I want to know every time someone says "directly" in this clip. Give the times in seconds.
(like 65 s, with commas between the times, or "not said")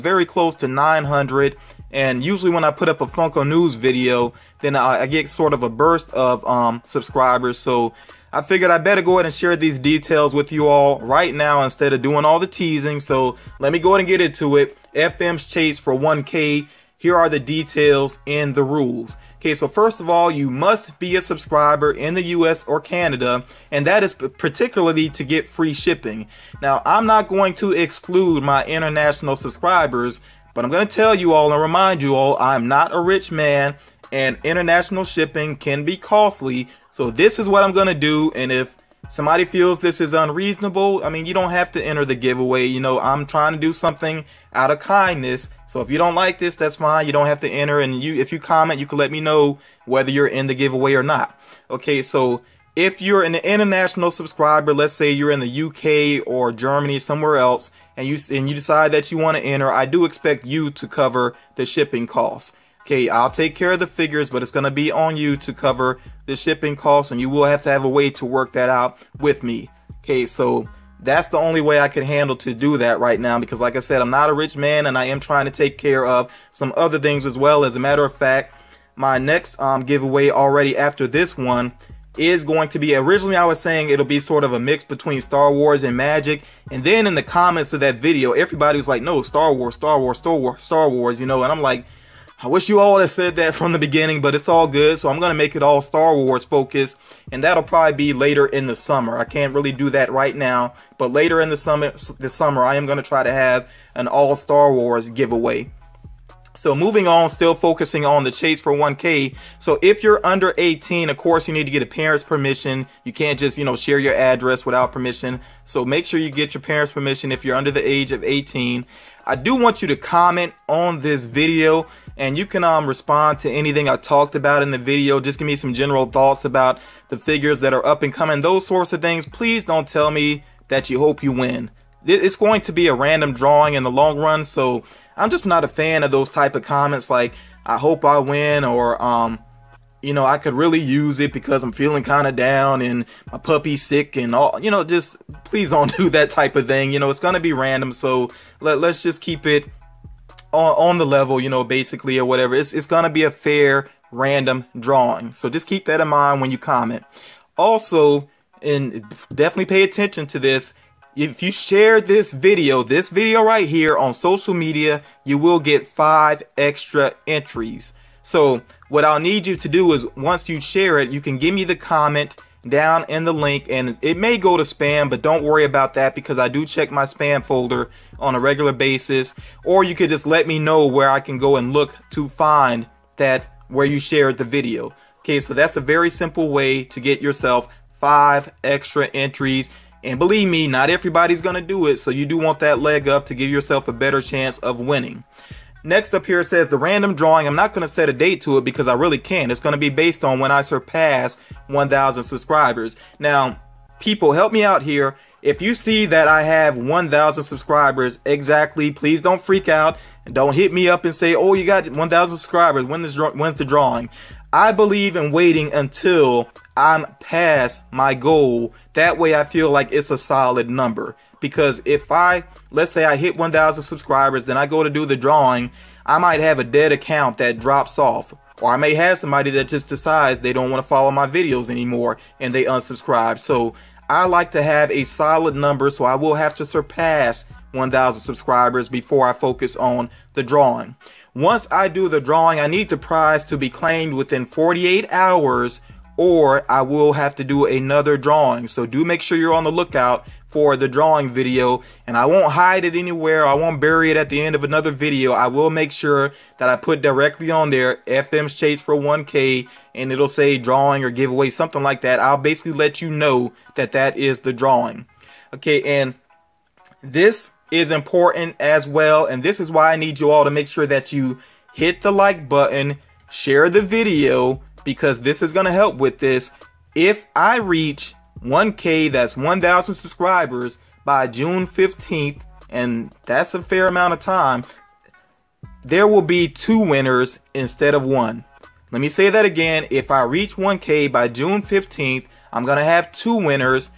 257 s.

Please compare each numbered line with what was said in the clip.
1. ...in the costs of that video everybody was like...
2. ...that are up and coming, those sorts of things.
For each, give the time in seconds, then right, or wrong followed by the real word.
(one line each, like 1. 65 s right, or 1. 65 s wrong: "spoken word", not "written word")
1. 87 s wrong: "comments", not "costs"
2. 127 s right.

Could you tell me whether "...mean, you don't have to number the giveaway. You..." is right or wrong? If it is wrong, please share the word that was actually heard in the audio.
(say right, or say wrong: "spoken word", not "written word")
wrong: "enter", not "number".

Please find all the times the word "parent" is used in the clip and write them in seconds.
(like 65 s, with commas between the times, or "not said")
111 s, 116 s.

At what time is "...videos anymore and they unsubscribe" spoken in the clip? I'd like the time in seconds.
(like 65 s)
231 s.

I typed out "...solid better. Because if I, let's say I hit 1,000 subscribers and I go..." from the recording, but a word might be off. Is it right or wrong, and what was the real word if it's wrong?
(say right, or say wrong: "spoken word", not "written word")
wrong: "number", not "better".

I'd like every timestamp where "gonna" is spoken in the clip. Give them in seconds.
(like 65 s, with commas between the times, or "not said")
95 s, 102 s.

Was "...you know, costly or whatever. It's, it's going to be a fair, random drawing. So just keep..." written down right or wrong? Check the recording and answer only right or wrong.
wrong.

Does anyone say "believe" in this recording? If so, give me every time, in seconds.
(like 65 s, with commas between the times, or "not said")
190 s, 214 s.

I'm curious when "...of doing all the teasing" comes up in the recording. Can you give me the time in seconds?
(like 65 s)
11 s.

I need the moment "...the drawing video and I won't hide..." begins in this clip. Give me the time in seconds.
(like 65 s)
250 s.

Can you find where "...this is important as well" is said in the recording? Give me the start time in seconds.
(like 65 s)
267 s.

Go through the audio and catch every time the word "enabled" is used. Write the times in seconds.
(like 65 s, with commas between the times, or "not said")
not said.